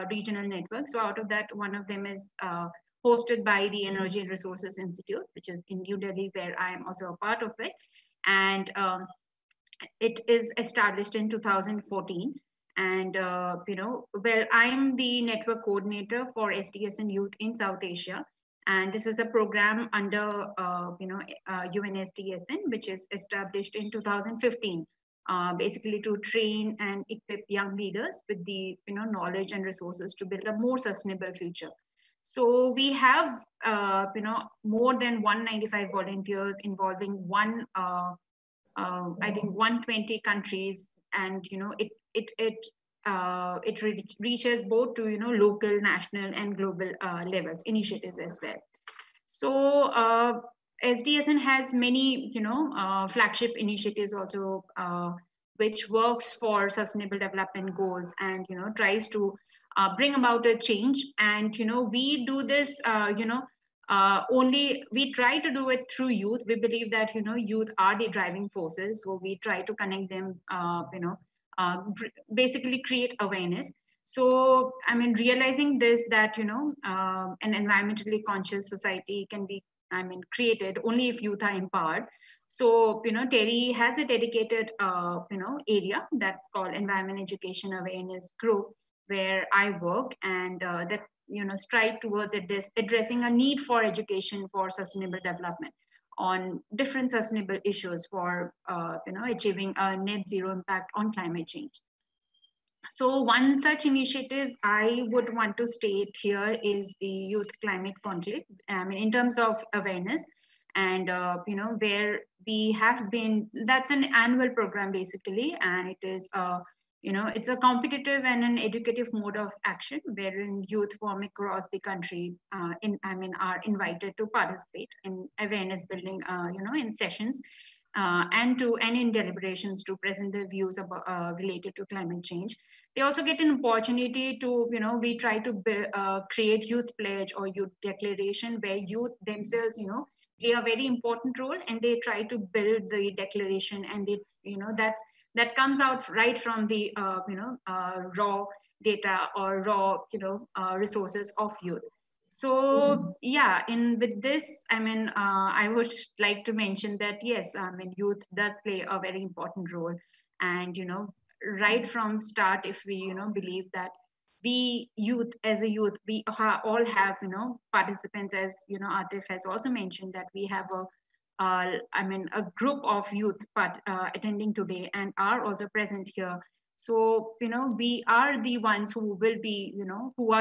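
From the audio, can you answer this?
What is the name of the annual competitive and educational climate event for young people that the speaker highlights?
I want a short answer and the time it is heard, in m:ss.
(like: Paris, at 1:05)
Youth Climate Conclave, at 1:47.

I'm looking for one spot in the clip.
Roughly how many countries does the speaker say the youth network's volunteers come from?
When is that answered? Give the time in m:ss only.
0:39.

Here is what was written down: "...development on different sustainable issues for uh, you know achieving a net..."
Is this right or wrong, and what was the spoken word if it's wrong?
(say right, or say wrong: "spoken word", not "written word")
right.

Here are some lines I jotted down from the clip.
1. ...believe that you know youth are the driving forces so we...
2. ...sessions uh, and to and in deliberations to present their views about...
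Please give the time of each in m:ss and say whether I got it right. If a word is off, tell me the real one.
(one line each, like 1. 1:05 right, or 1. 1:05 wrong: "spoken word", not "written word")
1. 1:06 right
2. 2:07 right.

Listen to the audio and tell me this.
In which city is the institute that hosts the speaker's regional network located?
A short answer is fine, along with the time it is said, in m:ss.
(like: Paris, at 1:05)
New Delhi, at 0:05.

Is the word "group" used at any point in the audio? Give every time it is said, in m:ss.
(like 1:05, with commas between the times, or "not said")
1:28, 2:52.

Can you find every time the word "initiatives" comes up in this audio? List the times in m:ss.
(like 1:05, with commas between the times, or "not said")
0:47, 0:53, 1:43.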